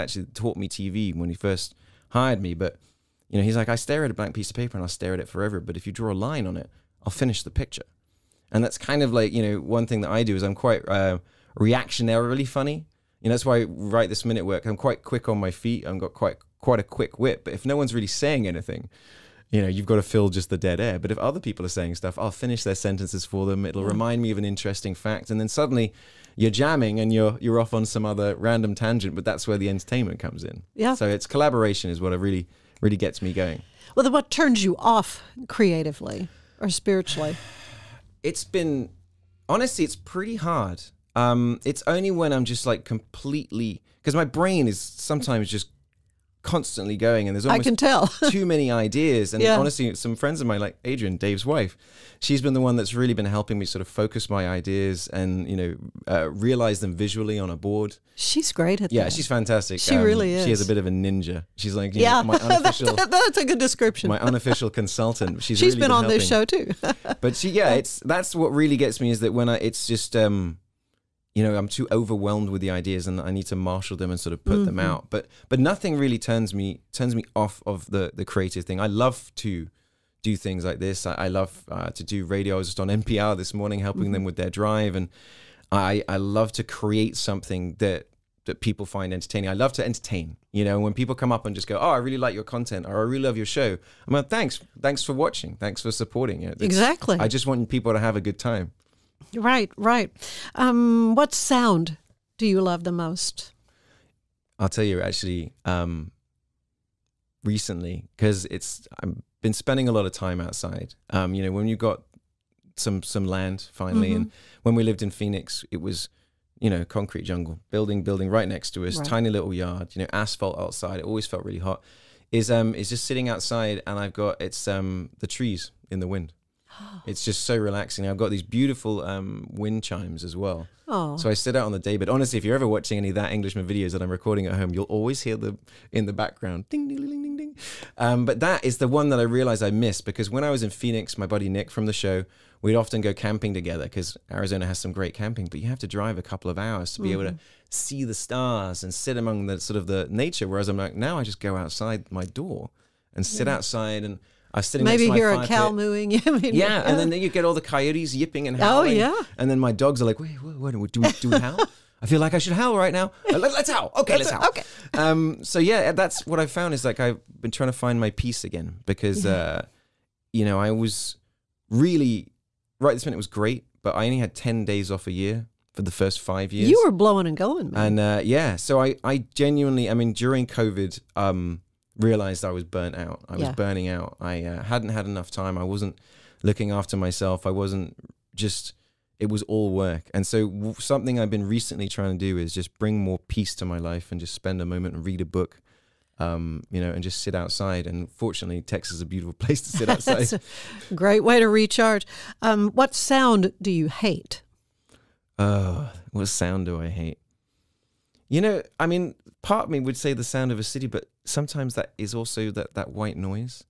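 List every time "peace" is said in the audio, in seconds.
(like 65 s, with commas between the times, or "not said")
168 s, 193 s.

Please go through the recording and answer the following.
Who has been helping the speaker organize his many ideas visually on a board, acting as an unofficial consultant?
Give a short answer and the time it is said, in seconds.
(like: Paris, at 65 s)
Adrian, at 50 s.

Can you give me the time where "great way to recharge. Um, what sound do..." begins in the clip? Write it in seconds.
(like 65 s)
200 s.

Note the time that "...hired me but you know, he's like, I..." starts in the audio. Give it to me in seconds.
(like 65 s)
2 s.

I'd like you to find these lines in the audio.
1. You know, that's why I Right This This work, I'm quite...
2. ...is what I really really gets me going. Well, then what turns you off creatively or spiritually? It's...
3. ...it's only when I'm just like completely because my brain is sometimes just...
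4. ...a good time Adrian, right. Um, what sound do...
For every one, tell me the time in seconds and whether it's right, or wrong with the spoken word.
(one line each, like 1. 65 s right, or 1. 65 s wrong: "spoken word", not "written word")
1. 13 s wrong: "Minute", not "This"
2. 31 s right
3. 41 s right
4. 98 s wrong: "Right", not "Adrian".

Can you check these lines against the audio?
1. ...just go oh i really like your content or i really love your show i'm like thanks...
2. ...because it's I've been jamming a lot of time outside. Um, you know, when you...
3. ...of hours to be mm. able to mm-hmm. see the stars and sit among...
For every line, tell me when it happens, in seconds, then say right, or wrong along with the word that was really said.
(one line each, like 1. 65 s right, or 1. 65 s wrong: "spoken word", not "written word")
1. 91 s right
2. 108 s wrong: "spending", not "jamming"
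3. 146 s right.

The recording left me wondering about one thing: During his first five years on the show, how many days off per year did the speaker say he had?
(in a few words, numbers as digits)
10.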